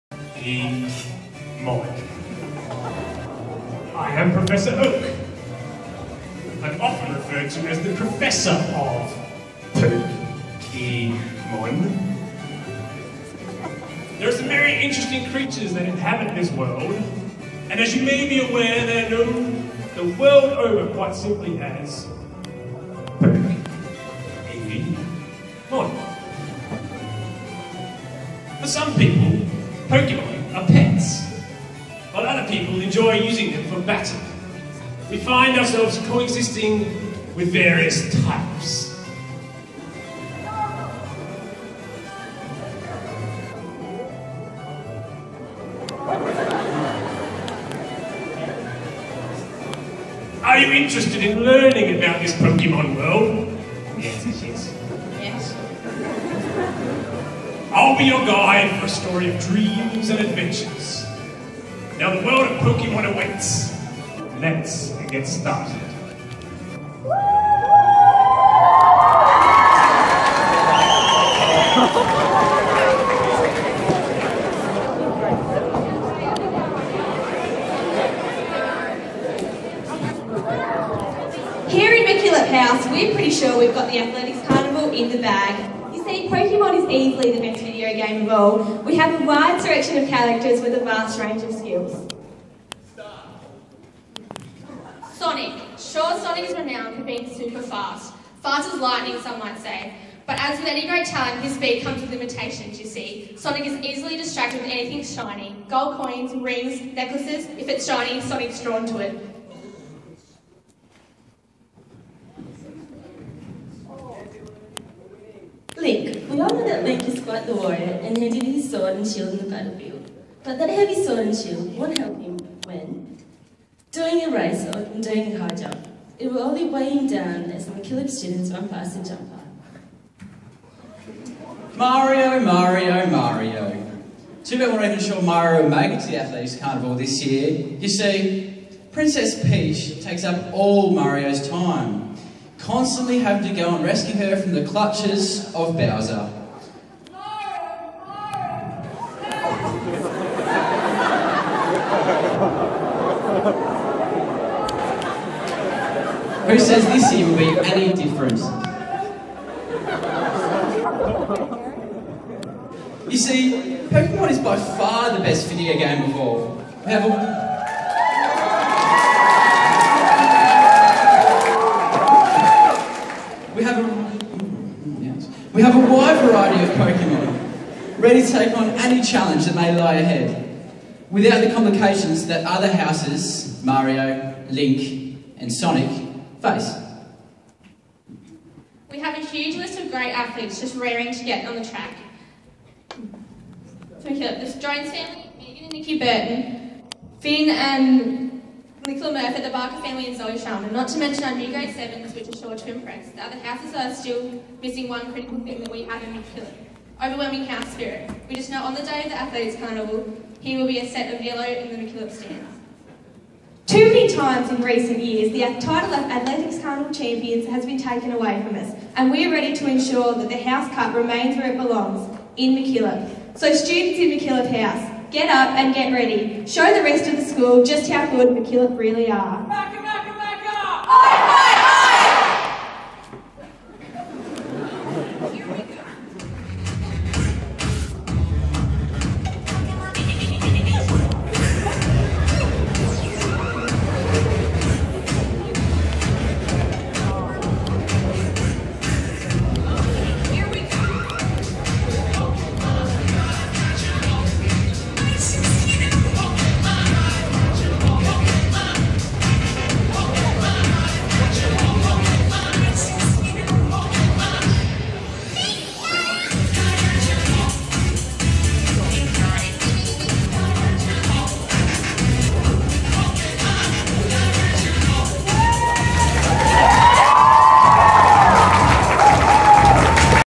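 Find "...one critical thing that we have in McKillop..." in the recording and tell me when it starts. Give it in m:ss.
3:24.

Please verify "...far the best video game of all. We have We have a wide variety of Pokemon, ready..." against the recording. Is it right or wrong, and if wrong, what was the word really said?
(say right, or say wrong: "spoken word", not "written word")
right.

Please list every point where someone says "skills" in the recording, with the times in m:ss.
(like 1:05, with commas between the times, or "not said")
1:31.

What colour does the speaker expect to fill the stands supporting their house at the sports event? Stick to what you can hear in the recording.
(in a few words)
Yellow.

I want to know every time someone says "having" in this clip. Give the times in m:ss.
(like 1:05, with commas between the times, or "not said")
2:23.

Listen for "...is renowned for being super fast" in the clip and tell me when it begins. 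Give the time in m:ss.
1:36.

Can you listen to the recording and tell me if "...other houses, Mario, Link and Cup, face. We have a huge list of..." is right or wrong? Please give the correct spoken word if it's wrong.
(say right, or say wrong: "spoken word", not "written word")
wrong: "Sonic", not "Cup".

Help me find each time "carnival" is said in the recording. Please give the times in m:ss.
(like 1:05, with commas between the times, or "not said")
1:24, 2:16, 3:29, 3:36.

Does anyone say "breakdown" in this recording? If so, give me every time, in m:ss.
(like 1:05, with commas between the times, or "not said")
not said.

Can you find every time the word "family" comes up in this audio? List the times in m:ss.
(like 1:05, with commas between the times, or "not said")
3:14, 3:19.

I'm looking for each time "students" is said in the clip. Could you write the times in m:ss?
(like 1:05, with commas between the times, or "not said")
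2:08, 3:43.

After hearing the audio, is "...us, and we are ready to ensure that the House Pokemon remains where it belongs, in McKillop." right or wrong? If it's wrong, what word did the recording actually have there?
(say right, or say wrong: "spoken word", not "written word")
wrong: "Cup", not "Pokemon".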